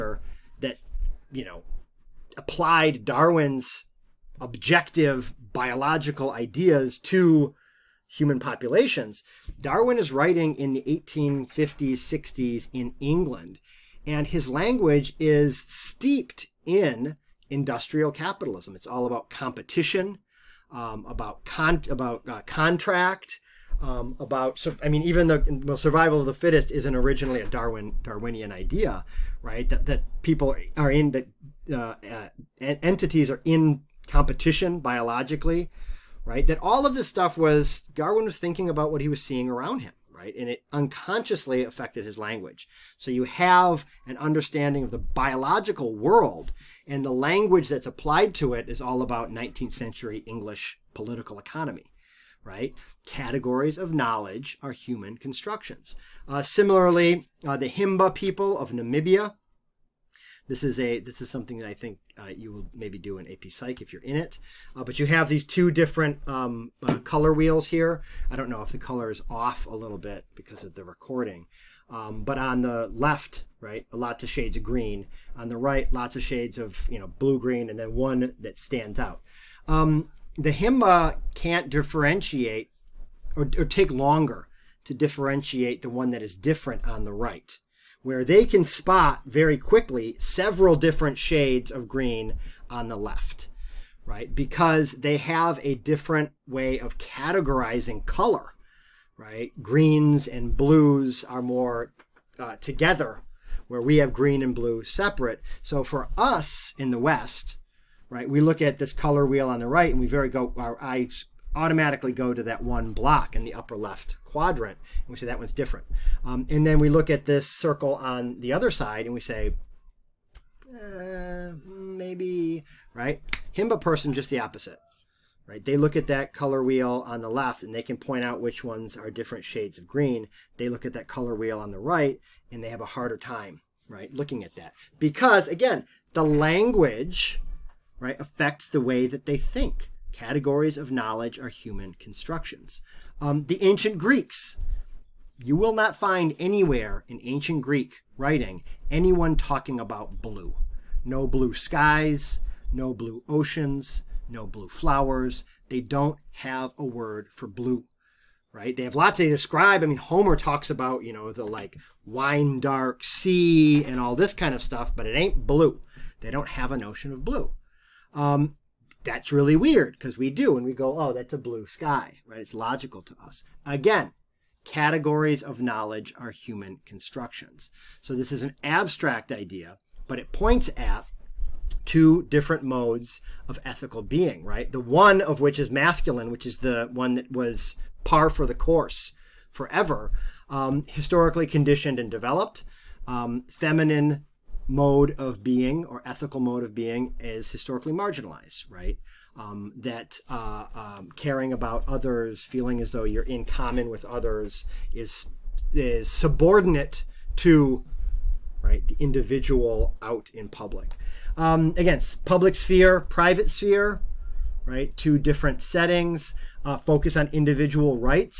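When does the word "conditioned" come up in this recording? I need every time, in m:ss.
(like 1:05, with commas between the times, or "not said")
3:11.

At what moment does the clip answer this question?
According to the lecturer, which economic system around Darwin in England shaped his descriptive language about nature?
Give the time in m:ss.
0:17.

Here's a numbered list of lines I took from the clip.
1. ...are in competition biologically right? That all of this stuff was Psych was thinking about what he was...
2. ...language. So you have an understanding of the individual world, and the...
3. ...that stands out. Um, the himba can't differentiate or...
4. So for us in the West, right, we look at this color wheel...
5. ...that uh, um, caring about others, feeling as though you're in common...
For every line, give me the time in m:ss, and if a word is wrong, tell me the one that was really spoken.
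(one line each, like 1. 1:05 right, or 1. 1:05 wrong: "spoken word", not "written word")
1. 0:33 wrong: "Darwin", not "Psych"
2. 0:42 wrong: "biological", not "individual"
3. 1:18 right
4. 1:45 right
5. 3:19 right.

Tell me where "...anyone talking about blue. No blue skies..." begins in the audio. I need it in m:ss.
2:28.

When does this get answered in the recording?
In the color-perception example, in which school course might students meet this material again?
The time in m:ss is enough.
1:03.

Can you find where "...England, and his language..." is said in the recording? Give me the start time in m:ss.
0:12.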